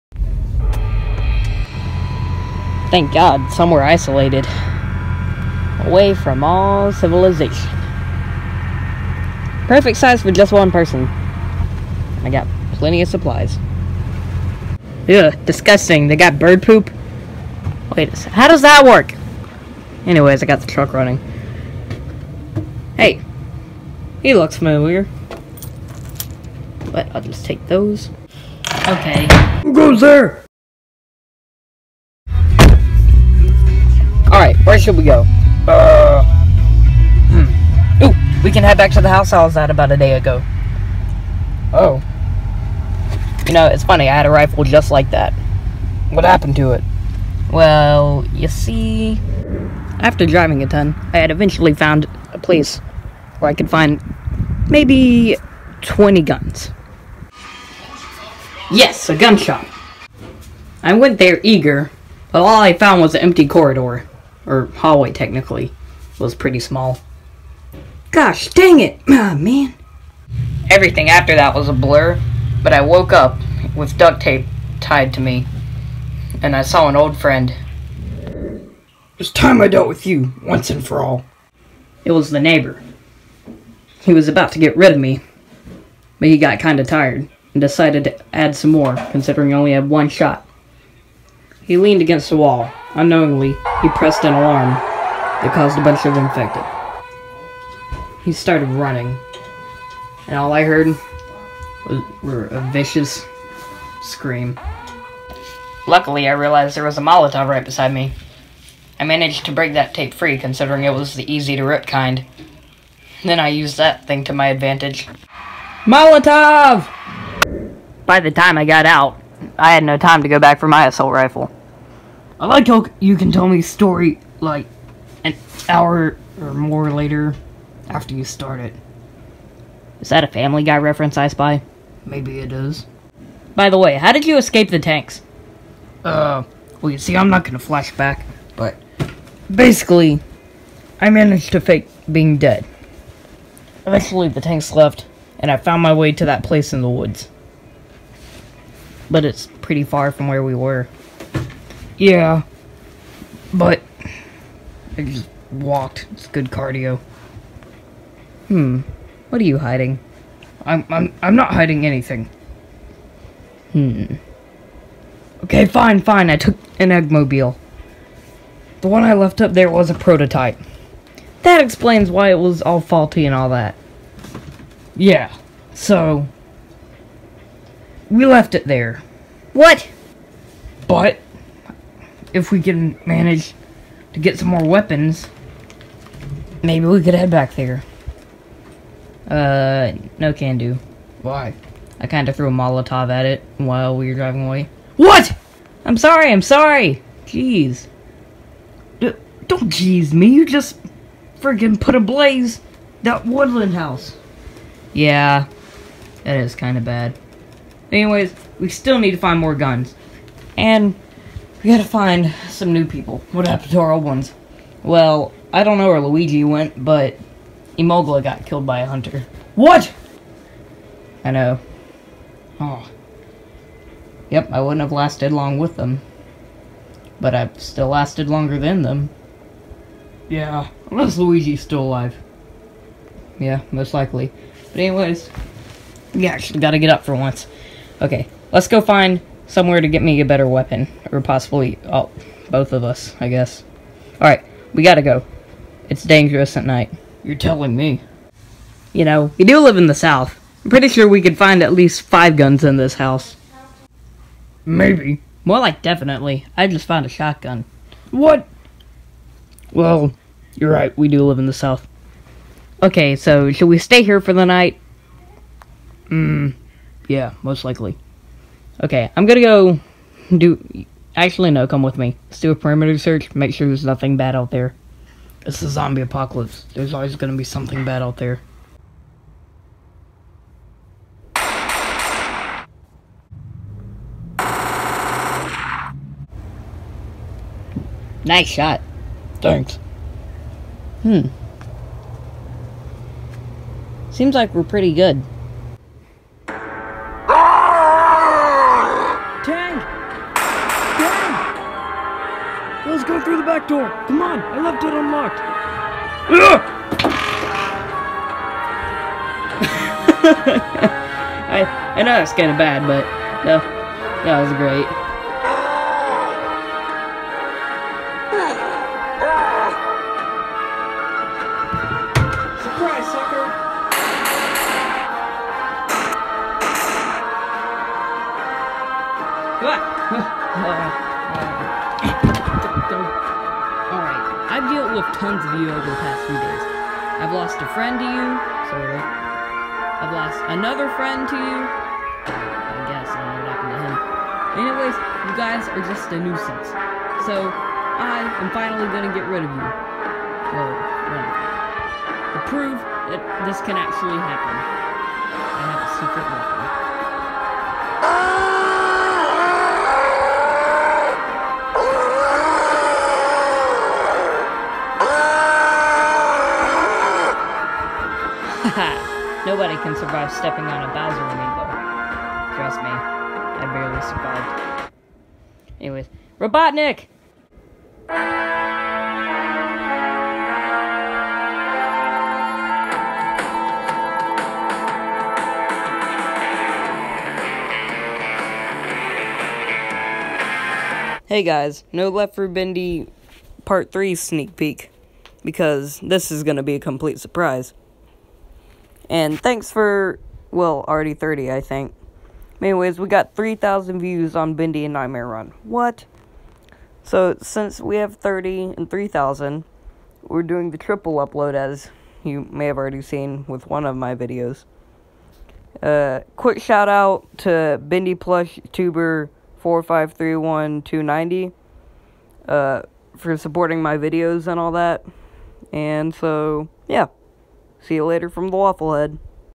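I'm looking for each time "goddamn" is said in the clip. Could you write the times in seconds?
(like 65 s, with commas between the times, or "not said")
not said.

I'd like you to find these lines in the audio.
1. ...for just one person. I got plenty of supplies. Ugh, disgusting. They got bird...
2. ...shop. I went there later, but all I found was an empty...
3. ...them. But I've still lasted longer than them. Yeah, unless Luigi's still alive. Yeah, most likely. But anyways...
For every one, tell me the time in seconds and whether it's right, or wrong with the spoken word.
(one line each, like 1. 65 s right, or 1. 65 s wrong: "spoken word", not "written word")
1. 10 s right
2. 59 s wrong: "eager", not "later"
3. 225 s right.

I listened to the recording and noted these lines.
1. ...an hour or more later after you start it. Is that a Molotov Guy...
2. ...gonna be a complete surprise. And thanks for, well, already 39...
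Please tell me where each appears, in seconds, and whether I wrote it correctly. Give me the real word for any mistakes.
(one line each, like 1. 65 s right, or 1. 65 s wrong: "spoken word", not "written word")
1. 125 s wrong: "Family", not "Molotov"
2. 396 s wrong: "30", not "39".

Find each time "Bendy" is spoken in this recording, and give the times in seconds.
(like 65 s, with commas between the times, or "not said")
392 s, 404 s, 417 s.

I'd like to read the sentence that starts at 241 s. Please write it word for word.
Or possibly oh, both of us, I guess.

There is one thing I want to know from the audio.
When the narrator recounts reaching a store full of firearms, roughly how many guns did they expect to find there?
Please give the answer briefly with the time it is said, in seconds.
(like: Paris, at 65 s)
20, at 55 s.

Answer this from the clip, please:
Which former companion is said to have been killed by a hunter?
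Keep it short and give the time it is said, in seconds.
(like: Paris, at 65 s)
Imogla, at 217 s.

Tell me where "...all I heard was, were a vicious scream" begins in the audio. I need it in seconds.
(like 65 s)
100 s.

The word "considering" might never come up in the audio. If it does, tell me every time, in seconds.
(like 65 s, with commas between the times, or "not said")
89 s, 110 s.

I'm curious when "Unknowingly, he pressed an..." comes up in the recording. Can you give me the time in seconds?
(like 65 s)
92 s.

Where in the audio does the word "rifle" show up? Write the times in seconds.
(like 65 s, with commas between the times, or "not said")
44 s, 121 s.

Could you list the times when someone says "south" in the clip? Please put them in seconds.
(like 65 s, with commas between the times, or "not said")
249 s, 261 s.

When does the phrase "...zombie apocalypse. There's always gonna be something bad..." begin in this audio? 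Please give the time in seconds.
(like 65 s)
275 s.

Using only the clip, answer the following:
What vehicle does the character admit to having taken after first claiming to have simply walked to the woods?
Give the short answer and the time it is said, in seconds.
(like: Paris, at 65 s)
eggmobile, at 166 s.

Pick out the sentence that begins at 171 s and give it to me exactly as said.
That explains why it was all faulty and all that.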